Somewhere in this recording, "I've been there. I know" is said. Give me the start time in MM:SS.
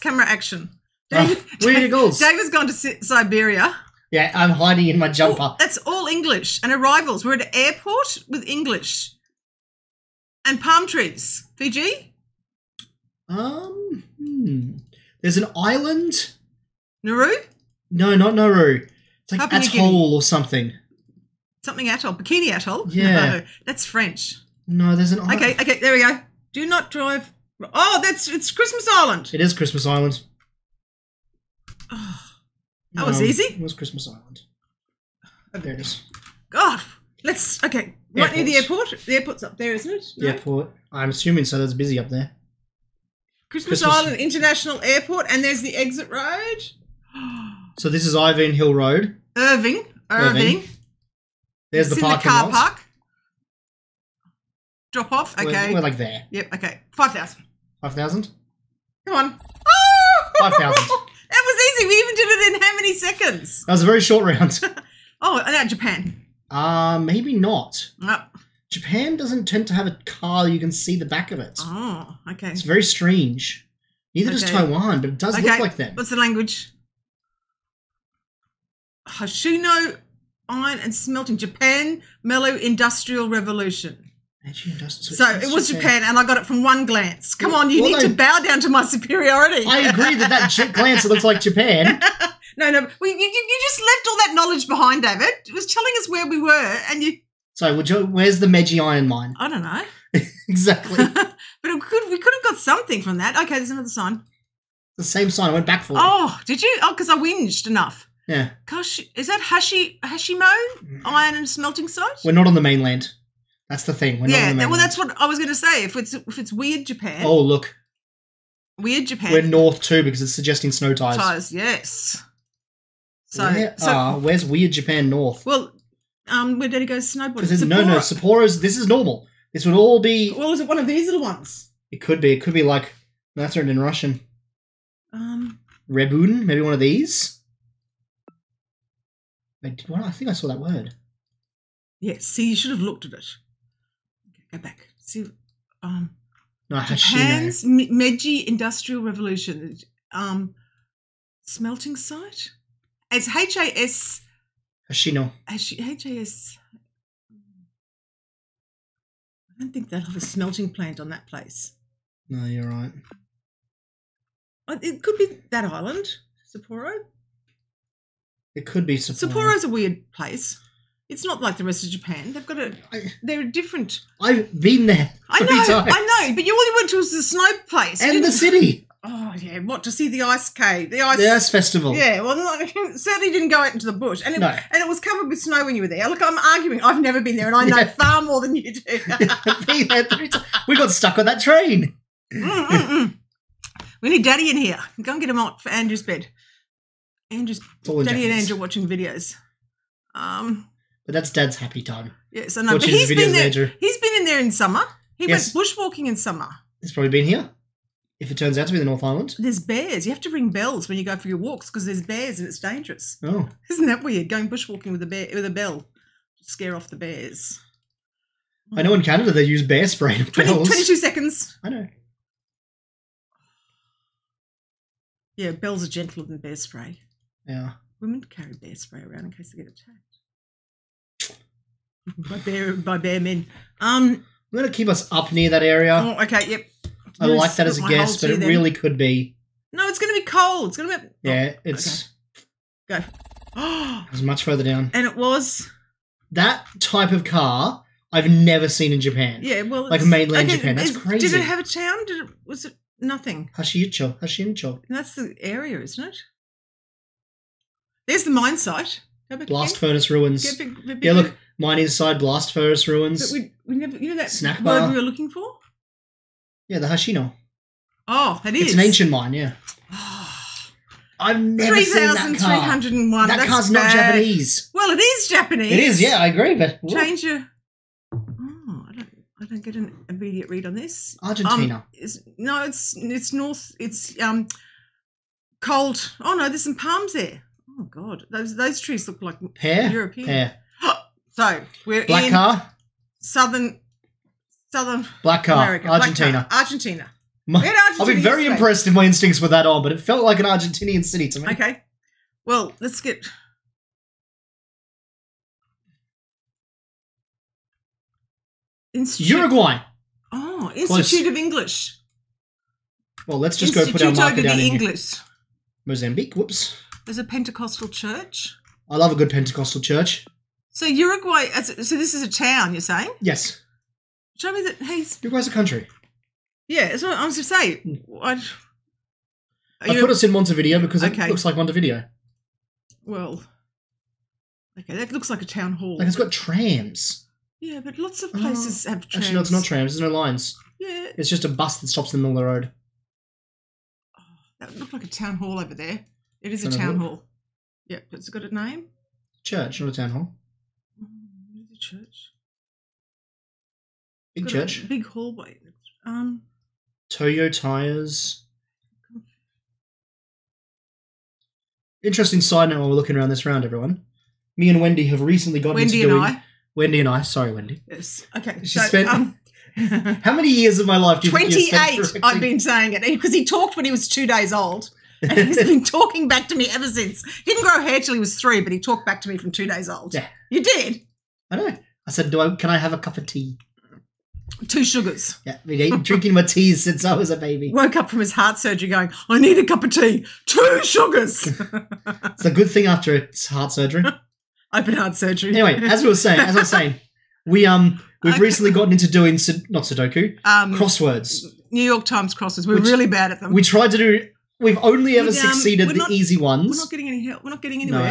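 02:54.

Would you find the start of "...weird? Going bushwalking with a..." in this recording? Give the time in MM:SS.
03:34.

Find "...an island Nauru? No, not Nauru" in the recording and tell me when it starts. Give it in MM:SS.
00:15.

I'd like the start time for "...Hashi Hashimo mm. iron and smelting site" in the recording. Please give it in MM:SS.
01:49.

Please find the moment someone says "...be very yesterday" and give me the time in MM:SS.
04:58.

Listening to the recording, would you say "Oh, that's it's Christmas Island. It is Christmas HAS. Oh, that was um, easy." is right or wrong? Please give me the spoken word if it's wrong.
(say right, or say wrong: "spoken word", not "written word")
wrong: "Island", not "HAS".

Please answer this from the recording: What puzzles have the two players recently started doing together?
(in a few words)
New York Times crosswords.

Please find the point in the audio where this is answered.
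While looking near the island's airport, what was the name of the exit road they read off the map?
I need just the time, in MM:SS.
00:48.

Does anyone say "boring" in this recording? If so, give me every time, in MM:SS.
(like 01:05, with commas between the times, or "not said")
not said.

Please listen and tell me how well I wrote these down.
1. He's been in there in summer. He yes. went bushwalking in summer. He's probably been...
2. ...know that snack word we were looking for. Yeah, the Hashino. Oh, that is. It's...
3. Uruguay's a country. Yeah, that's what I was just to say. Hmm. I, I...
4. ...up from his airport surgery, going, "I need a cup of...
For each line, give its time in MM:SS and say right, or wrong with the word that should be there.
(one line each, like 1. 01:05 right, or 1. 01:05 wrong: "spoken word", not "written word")
1. 03:23 right
2. 04:24 right
3. 05:25 right
4. 06:27 wrong: "heart", not "airport".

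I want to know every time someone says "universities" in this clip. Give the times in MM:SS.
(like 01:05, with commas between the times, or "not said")
not said.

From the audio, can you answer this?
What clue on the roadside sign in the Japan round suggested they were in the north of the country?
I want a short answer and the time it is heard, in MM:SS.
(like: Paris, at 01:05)
snow tires, at 02:00.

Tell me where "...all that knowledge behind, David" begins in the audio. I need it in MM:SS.
01:34.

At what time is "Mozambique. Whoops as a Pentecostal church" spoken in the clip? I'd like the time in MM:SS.
05:15.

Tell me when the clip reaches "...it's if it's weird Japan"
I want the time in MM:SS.
01:55.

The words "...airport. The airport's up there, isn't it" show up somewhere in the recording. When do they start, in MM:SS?
00:38.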